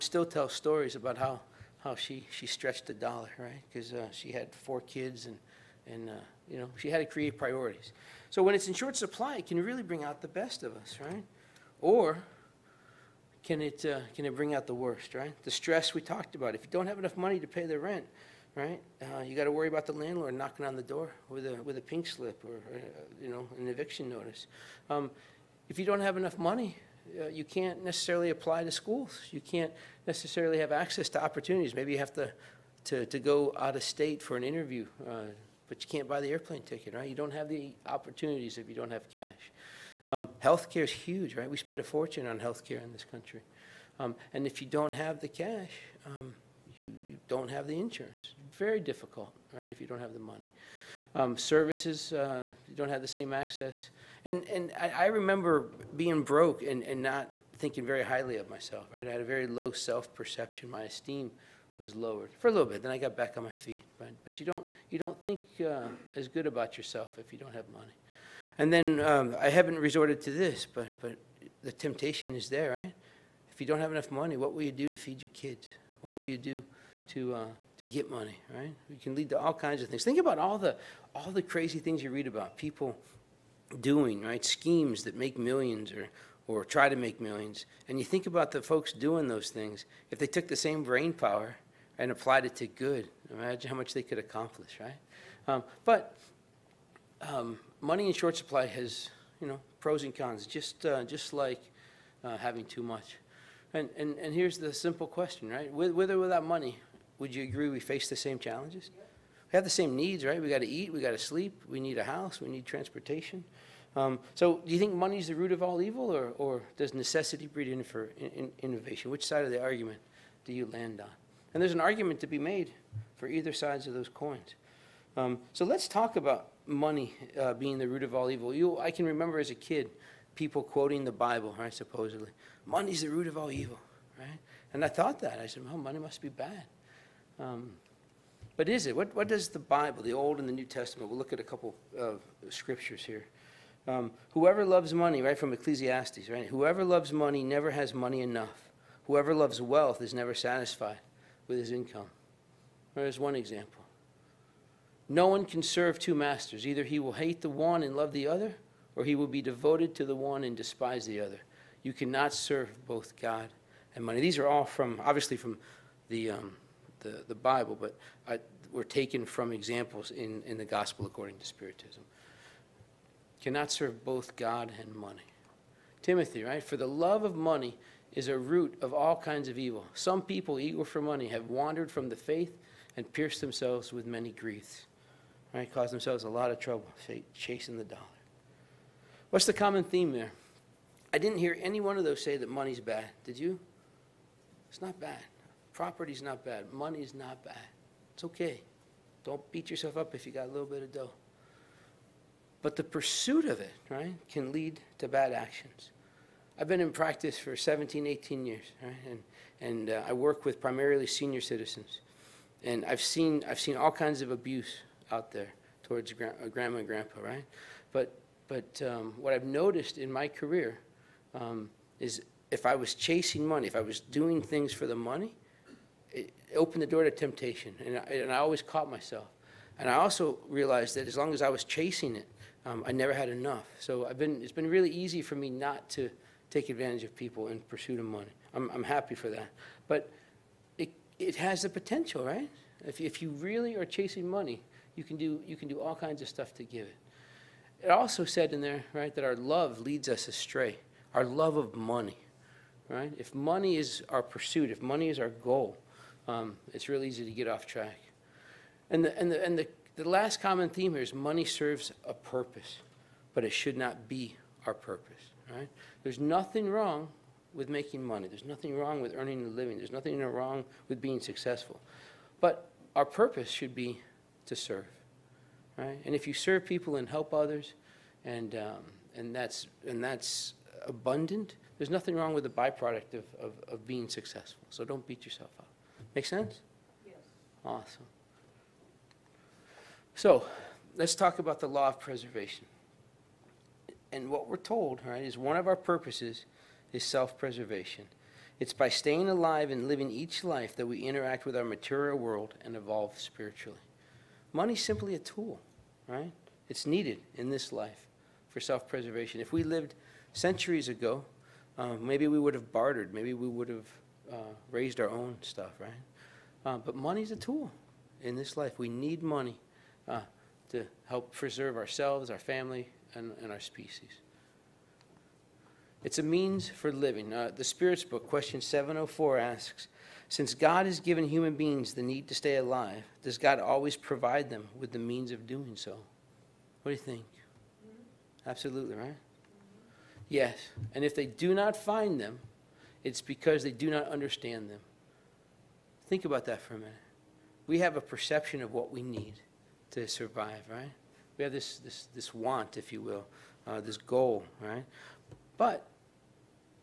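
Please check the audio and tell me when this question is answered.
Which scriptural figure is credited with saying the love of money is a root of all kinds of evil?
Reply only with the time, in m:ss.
2:56.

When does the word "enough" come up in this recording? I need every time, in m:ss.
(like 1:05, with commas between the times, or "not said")
0:16, 0:26, 1:13, 2:28, 3:53.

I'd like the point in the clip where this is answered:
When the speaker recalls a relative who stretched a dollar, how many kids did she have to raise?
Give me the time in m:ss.
0:04.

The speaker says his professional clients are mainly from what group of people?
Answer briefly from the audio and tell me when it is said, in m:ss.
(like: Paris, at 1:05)
Senior citizens, at 3:31.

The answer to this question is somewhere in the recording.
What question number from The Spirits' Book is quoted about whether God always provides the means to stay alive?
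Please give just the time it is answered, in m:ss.
5:28.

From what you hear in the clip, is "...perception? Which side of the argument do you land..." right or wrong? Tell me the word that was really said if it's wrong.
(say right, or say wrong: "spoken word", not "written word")
wrong: "innovation", not "perception".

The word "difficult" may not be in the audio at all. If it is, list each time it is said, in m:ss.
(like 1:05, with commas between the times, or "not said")
0:48.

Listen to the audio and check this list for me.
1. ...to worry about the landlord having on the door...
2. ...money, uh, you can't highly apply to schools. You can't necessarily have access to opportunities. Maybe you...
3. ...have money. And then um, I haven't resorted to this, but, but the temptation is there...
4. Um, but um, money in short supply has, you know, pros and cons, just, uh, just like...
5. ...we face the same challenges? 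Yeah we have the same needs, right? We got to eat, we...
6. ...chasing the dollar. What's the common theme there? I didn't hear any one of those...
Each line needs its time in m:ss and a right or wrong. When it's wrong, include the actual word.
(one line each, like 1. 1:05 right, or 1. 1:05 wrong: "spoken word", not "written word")
1. 0:19 wrong: "knocking", not "having"
2. 0:26 wrong: "necessarily", not "highly"
3. 1:07 right
4. 1:35 right
5. 1:47 right
6. 3:07 right.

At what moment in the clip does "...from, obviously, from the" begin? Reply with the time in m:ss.
2:44.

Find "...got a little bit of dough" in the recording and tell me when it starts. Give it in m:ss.
3:20.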